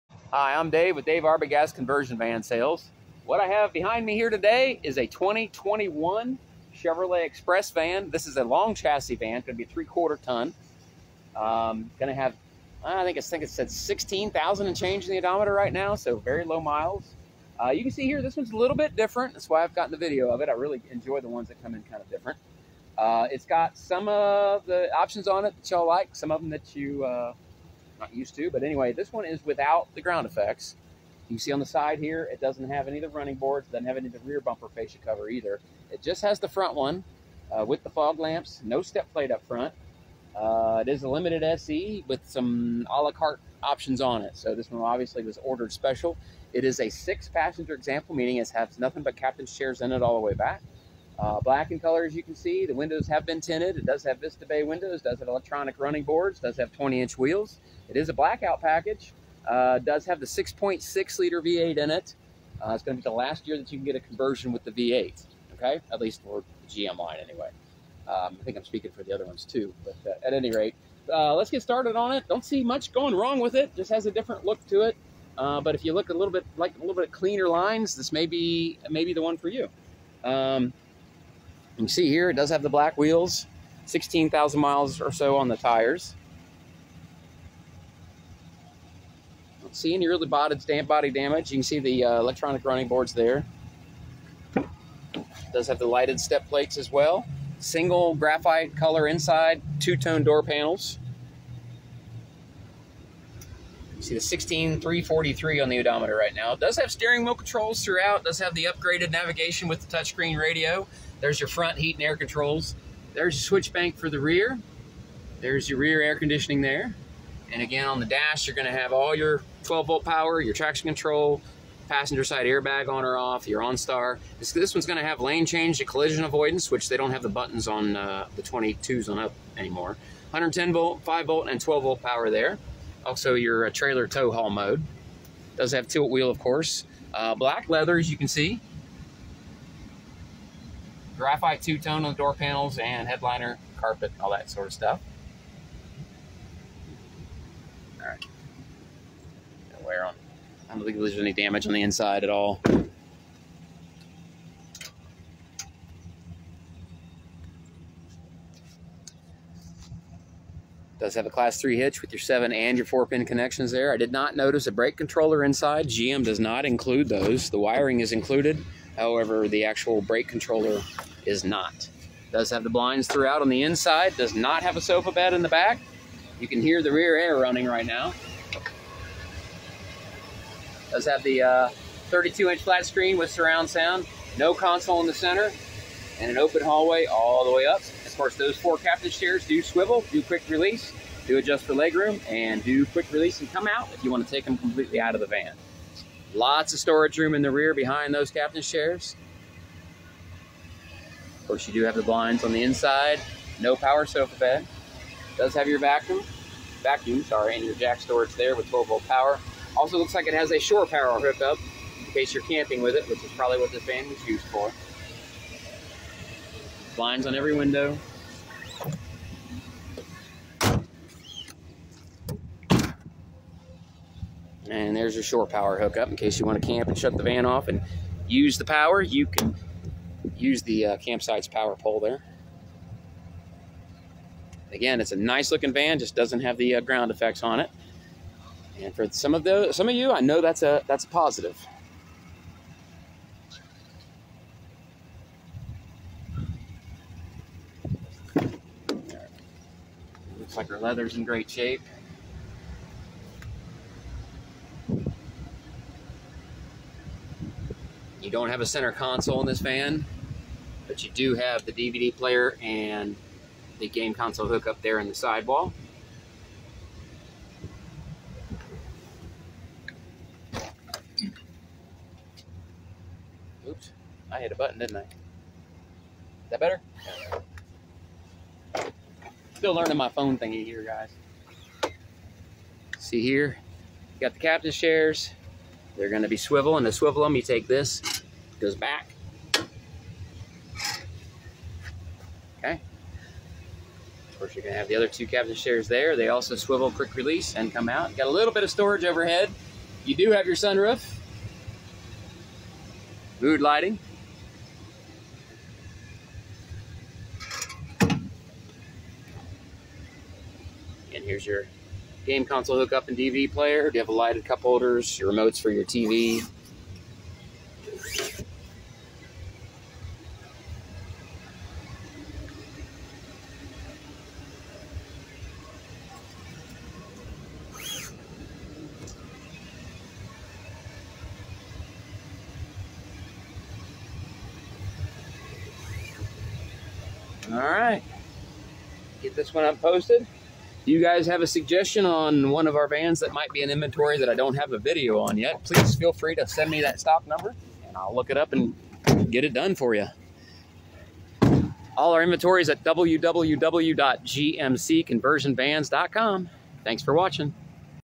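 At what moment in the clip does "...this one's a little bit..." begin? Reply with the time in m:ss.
0:18.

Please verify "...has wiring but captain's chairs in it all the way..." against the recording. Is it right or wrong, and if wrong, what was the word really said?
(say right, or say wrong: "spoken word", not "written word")
wrong: "nothing", not "wiring".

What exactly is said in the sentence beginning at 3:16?
Lots of storage room in the rear behind those captain's chairs.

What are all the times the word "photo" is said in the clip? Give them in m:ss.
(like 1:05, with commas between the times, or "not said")
not said.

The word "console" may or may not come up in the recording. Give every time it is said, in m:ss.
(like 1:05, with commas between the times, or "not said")
3:04, 4:18, 4:24, 5:12.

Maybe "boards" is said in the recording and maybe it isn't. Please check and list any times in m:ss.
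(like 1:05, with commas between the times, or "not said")
0:33, 0:56, 1:32.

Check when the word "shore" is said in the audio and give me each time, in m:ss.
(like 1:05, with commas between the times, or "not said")
3:30, 3:45.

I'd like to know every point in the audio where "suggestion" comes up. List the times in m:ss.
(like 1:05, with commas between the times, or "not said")
5:41.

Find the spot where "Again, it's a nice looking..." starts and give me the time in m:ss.
3:54.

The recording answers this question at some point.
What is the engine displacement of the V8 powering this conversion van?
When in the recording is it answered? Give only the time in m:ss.
1:00.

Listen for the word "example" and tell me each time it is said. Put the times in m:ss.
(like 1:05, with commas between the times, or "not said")
0:47.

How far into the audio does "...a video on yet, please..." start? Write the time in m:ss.
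5:44.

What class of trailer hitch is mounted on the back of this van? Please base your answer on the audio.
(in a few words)
Class 3.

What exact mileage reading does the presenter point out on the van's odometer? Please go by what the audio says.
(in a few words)
16343.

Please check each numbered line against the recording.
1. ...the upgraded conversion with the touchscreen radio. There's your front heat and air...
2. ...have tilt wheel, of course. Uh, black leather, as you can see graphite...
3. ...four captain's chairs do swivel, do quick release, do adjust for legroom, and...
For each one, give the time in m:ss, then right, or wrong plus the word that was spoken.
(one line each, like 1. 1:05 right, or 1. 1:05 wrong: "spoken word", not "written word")
1. 1:48 wrong: "navigation", not "conversion"
2. 2:15 right
3. 3:08 right.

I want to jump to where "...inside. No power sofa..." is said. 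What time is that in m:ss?
3:22.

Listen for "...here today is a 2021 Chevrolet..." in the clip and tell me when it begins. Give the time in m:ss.
0:04.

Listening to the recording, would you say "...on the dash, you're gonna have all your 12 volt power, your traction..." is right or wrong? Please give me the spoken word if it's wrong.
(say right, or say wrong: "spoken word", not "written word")
right.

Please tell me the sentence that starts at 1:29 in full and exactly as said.
Don't see any really body, damage.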